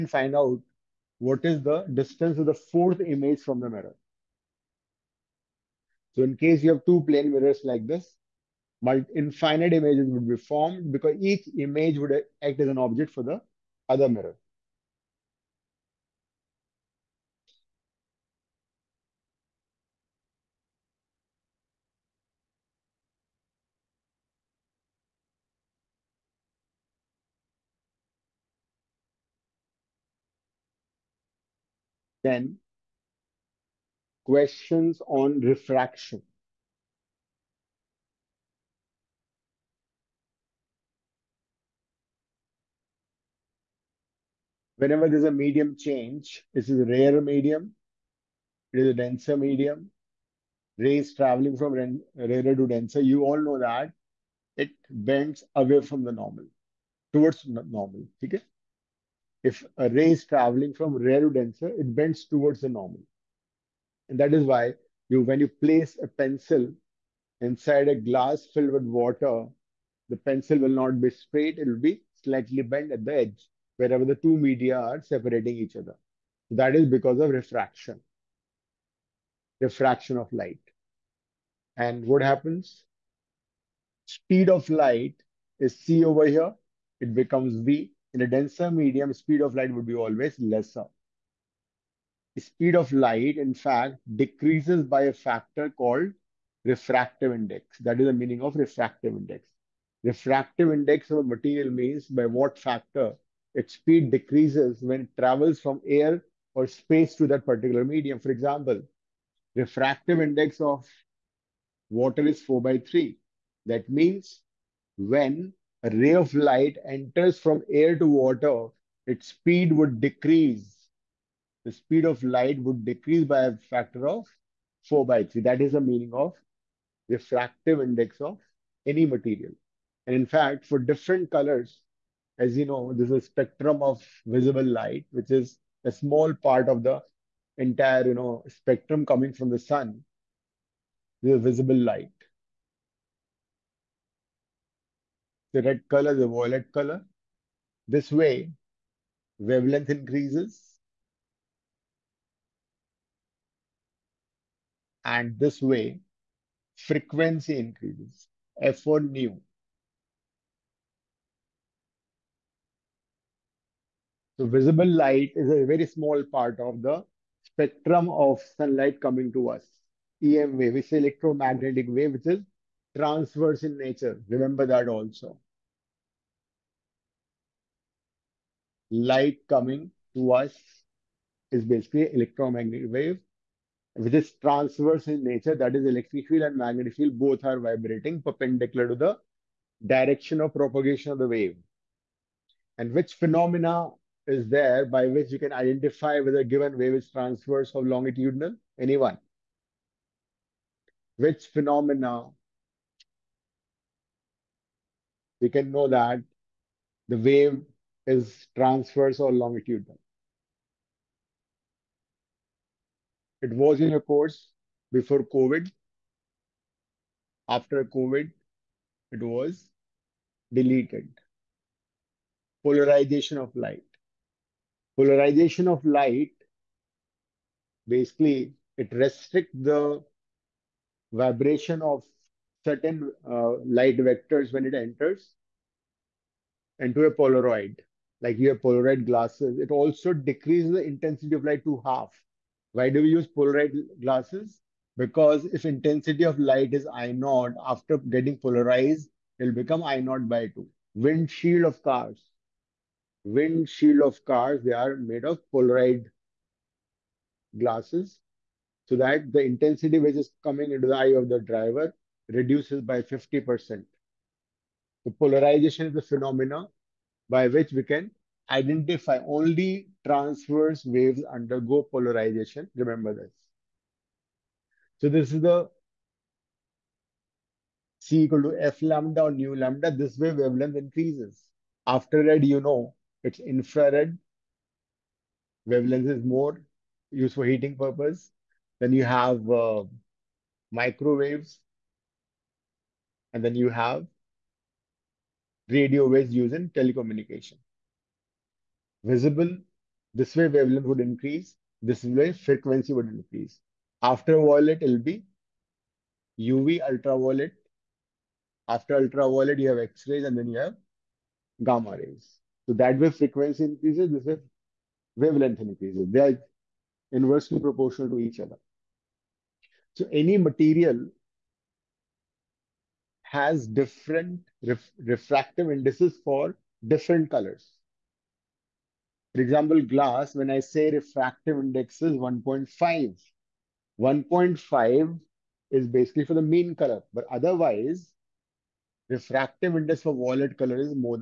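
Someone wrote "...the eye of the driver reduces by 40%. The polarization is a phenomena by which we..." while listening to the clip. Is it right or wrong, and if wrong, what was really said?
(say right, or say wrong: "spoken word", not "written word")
wrong: "50", not "40".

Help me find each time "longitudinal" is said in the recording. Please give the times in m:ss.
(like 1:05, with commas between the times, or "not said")
3:17, 3:29.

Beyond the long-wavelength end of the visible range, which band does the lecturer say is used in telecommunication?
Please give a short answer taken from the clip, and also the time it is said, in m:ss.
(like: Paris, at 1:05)
Radio waves, at 4:55.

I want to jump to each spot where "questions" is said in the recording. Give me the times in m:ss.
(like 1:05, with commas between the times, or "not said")
0:34.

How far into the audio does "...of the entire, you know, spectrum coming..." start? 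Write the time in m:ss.
2:16.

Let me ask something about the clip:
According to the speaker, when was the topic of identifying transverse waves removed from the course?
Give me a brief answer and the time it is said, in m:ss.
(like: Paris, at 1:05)
After COVID, at 3:37.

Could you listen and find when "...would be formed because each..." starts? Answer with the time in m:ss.
0:10.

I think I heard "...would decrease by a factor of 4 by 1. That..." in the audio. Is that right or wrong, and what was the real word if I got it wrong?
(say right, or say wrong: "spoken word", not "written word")
wrong: "3", not "1".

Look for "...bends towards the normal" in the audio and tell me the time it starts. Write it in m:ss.
1:01.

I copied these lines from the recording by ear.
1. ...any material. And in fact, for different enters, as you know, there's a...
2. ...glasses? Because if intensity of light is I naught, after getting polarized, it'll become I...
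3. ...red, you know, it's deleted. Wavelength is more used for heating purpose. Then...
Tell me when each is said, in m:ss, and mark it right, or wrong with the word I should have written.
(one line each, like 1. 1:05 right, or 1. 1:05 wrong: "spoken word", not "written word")
1. 2:08 wrong: "colors", not "enters"
2. 4:04 right
3. 4:42 wrong: "infrared", not "deleted".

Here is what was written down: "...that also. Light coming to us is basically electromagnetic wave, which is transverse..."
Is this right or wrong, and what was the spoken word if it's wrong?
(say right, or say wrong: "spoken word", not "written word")
right.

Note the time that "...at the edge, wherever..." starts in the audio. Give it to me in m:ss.
1:12.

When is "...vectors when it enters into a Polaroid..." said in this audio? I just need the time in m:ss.
3:53.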